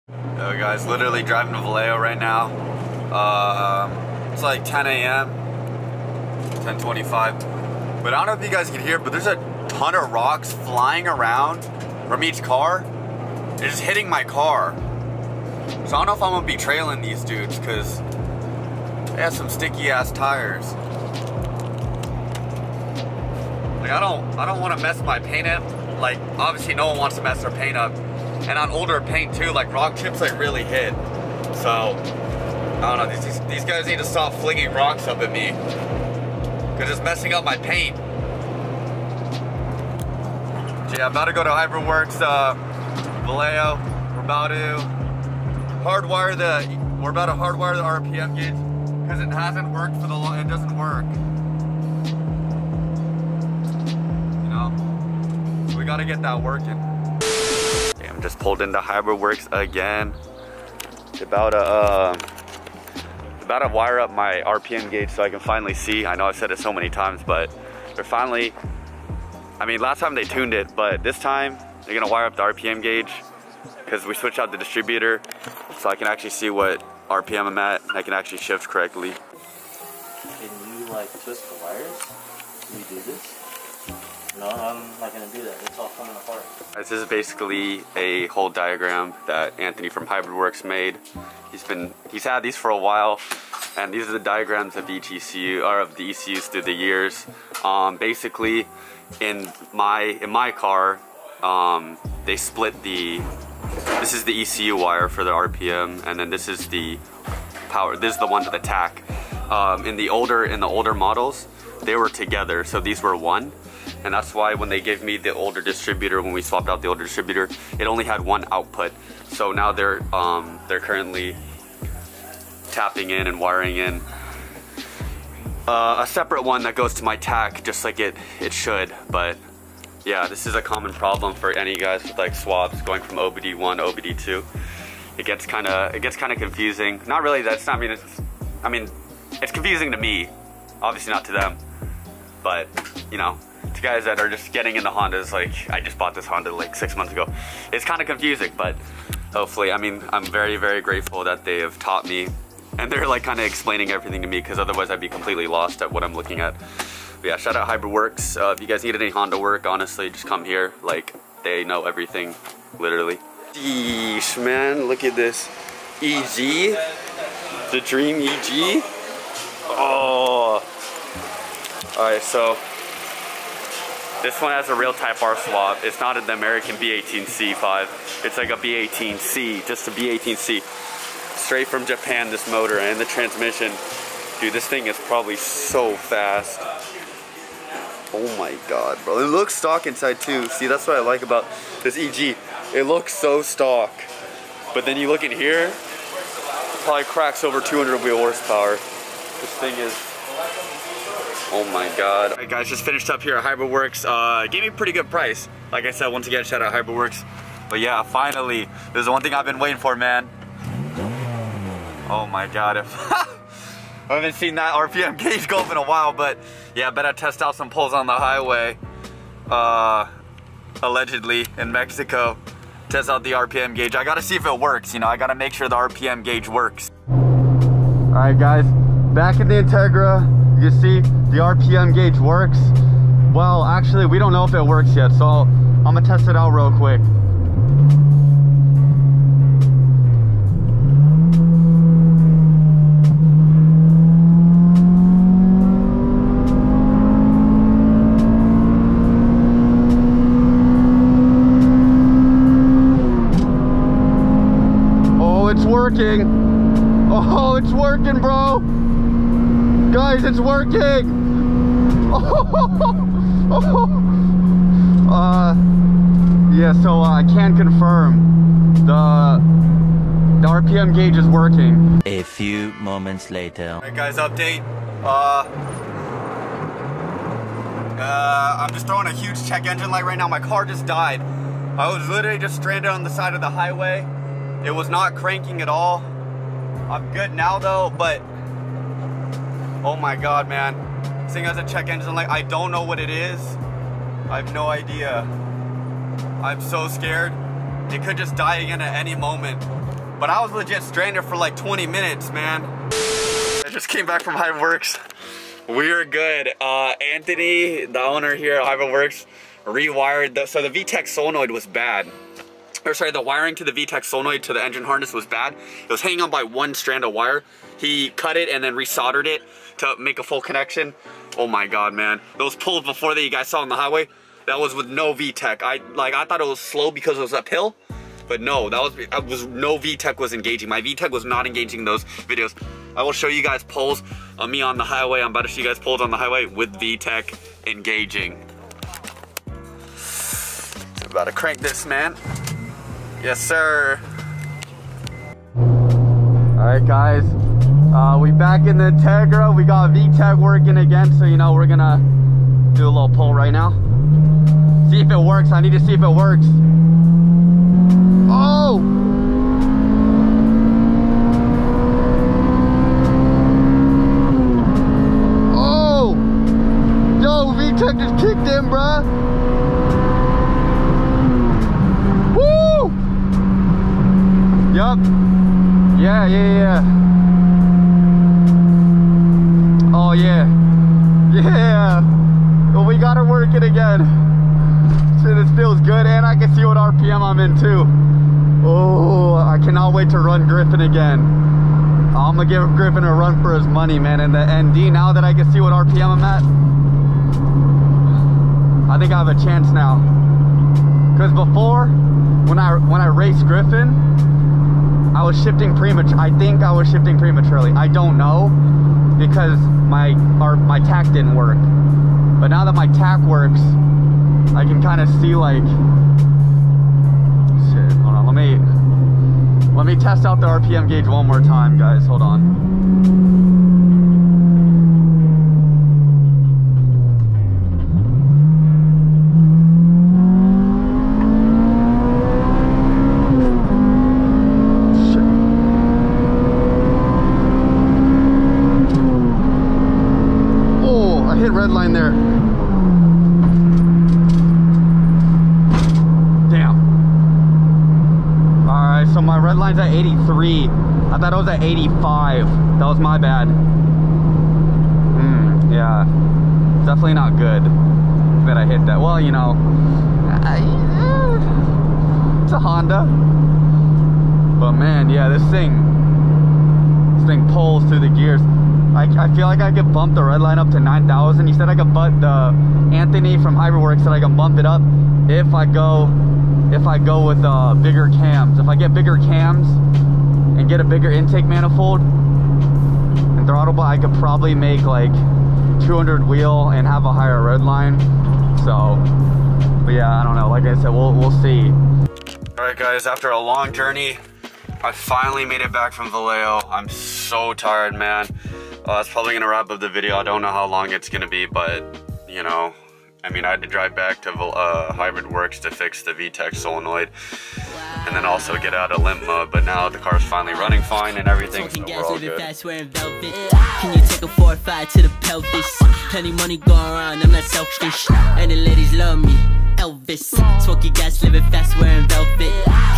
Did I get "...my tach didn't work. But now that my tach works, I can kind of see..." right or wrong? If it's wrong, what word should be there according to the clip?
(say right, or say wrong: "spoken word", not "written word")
right.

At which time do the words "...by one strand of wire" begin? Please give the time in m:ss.
5:16.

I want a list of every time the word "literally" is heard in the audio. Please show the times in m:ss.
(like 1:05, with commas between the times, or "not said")
0:00, 2:42, 4:42.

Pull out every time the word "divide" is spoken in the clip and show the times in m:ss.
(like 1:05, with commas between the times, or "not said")
not said.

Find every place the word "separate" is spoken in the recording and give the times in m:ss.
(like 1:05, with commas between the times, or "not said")
2:06.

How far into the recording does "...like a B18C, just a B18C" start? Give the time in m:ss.
2:58.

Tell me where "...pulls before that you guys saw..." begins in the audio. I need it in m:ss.
5:22.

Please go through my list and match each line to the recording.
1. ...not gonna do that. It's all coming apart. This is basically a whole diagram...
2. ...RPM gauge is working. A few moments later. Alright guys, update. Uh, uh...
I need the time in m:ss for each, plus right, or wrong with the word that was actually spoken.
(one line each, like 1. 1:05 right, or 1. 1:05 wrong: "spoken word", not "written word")
1. 1:25 right
2. 4:30 right.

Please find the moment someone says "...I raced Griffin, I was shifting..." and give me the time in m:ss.
6:42.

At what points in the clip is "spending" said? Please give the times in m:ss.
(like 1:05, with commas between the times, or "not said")
not said.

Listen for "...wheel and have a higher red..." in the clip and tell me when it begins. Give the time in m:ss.
8:06.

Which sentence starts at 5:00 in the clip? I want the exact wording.
But I was legit stranded for like 20 minutes, man.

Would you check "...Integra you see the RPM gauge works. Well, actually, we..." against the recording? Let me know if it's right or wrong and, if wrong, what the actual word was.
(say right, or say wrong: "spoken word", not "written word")
right.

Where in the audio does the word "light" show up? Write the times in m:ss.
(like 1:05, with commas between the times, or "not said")
4:39, 4:52.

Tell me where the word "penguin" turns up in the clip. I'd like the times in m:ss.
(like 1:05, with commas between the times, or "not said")
not said.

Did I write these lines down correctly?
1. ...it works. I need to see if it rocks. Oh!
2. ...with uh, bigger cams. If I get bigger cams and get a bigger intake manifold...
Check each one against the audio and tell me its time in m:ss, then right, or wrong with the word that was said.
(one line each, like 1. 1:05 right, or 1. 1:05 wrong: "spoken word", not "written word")
1. 5:55 wrong: "works", not "rocks"
2. 7:57 right.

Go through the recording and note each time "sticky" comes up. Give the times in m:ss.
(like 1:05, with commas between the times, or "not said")
0:19.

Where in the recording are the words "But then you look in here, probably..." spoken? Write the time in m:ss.
3:14.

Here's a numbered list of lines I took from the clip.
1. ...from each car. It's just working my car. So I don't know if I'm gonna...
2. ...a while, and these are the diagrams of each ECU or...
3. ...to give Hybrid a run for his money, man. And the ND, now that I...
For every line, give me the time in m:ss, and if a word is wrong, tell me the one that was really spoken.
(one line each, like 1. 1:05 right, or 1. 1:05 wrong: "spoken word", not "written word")
1. 0:12 wrong: "hitting", not "working"
2. 1:32 right
3. 6:32 wrong: "Griffin", not "Hybrid".